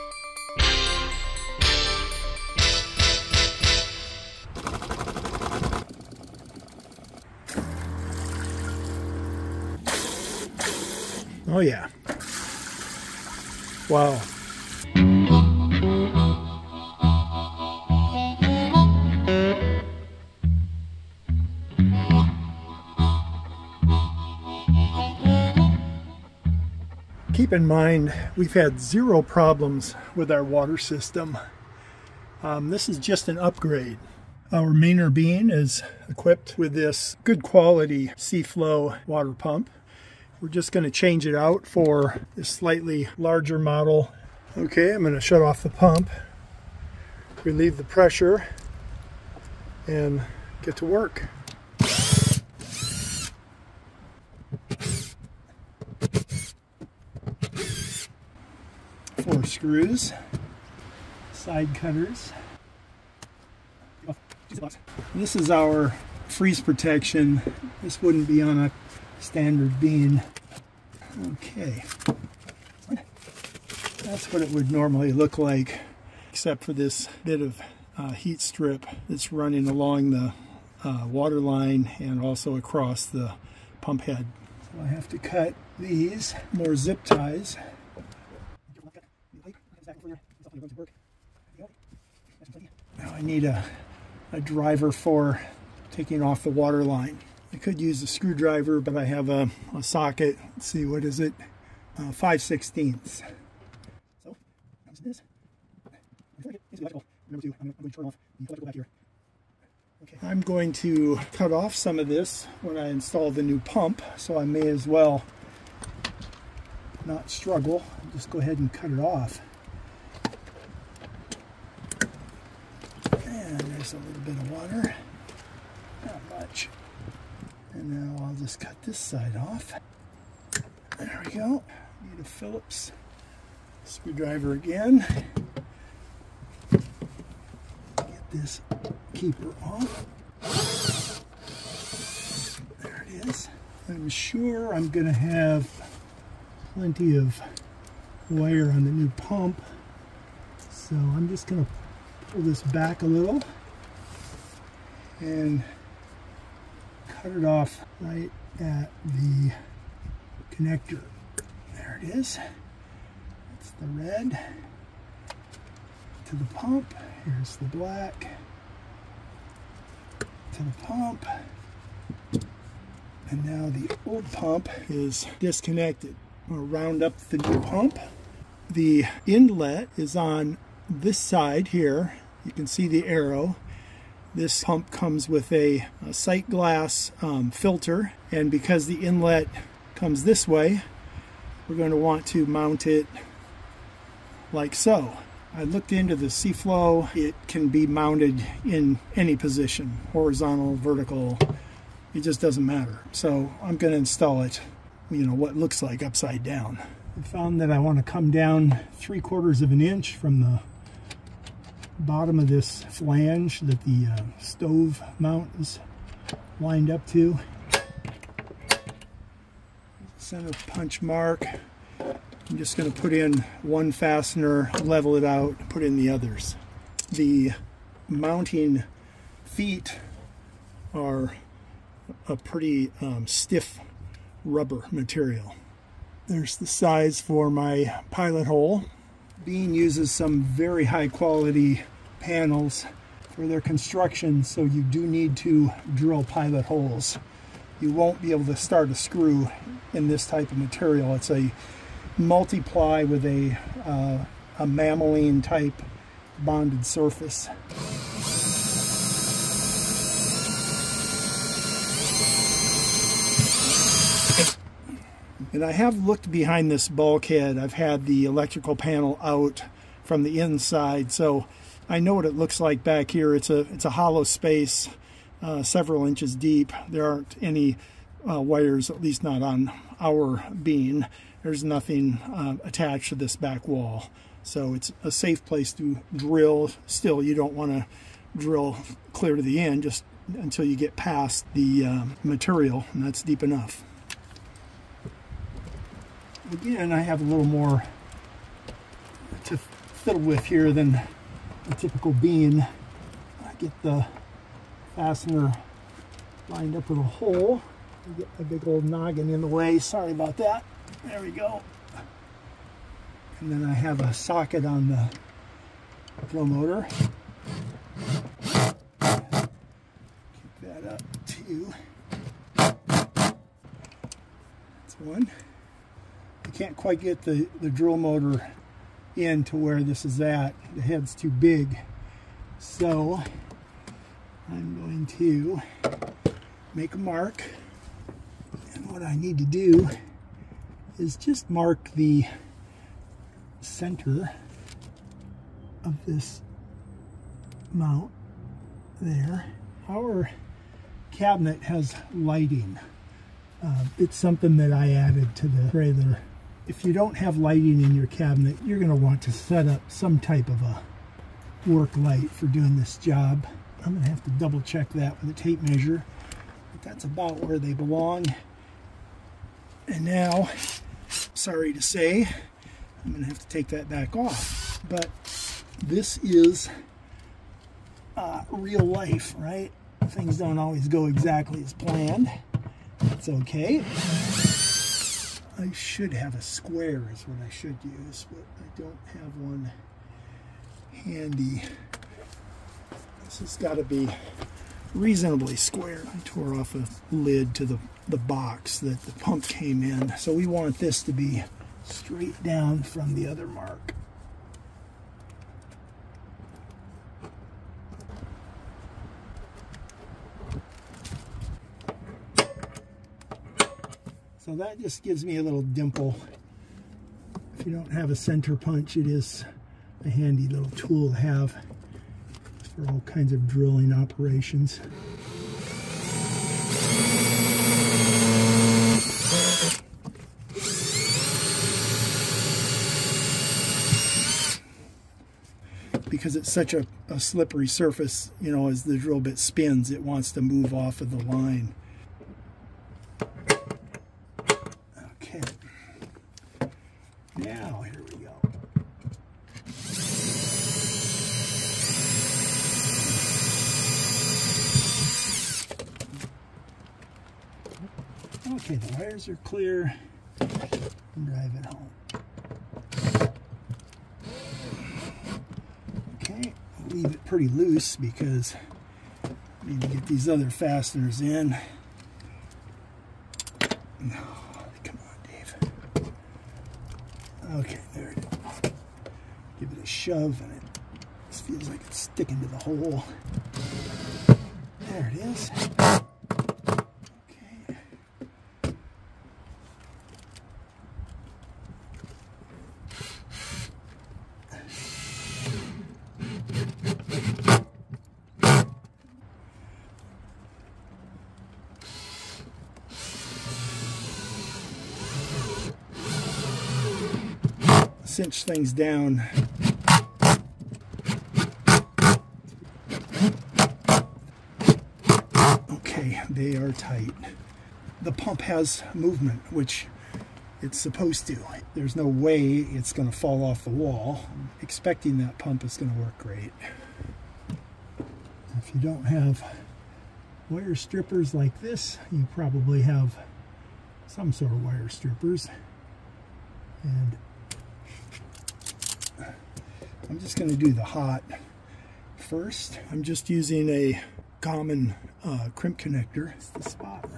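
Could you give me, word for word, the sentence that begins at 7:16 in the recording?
because it's such a, a, slippery surface, you know, as the drill bit spins, it wants to move off of the line.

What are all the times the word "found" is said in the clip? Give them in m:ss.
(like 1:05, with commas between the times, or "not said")
3:27.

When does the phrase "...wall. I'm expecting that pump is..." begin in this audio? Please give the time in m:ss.
8:43.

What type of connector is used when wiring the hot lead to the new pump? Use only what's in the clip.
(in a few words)
crimp connector.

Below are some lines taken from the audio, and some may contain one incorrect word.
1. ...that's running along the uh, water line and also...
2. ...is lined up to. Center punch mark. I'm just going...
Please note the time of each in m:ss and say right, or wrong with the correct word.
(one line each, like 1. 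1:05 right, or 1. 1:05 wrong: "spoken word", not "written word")
1. 1:19 right
2. 3:35 right.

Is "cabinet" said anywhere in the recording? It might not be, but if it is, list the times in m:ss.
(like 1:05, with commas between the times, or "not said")
5:51, 5:58.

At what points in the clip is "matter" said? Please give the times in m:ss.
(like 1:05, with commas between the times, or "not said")
3:22.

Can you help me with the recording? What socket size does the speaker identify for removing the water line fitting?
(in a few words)
5/16.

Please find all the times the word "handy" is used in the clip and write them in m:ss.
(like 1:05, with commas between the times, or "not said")
6:30, 7:00.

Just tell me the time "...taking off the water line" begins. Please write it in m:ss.
1:35.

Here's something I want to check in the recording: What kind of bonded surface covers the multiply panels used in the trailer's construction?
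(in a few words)
melamine.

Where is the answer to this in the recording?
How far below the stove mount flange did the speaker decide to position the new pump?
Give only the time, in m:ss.
3:28.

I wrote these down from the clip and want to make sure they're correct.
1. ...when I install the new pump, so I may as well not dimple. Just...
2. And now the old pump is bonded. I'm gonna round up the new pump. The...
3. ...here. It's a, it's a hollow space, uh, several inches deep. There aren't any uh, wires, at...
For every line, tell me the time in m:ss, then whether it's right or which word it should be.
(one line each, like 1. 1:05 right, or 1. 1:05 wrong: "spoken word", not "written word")
1. 1:52 wrong: "struggle", not "dimple"
2. 2:53 wrong: "disconnected", not "bonded"
3. 4:33 right.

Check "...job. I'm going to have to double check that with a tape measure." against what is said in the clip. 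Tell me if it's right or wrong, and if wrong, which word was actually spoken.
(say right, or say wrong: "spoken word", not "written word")
right.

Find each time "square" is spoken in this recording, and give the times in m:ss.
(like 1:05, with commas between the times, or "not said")
6:26, 6:35.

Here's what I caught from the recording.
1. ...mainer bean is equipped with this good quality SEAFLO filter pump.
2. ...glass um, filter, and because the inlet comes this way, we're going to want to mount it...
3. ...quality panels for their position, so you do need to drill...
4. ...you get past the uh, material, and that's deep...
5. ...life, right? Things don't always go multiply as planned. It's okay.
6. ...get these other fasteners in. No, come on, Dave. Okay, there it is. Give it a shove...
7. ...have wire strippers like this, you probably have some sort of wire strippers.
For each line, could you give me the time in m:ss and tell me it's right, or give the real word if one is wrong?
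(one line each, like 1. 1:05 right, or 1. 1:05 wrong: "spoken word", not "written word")
1. 0:34 wrong: "water", not "filter"
2. 3:06 right
3. 4:01 wrong: "construction", not "position"
4. 4:50 right
5. 6:18 wrong: "exactly", not "multiply"
6. 7:49 right
7. 8:49 right.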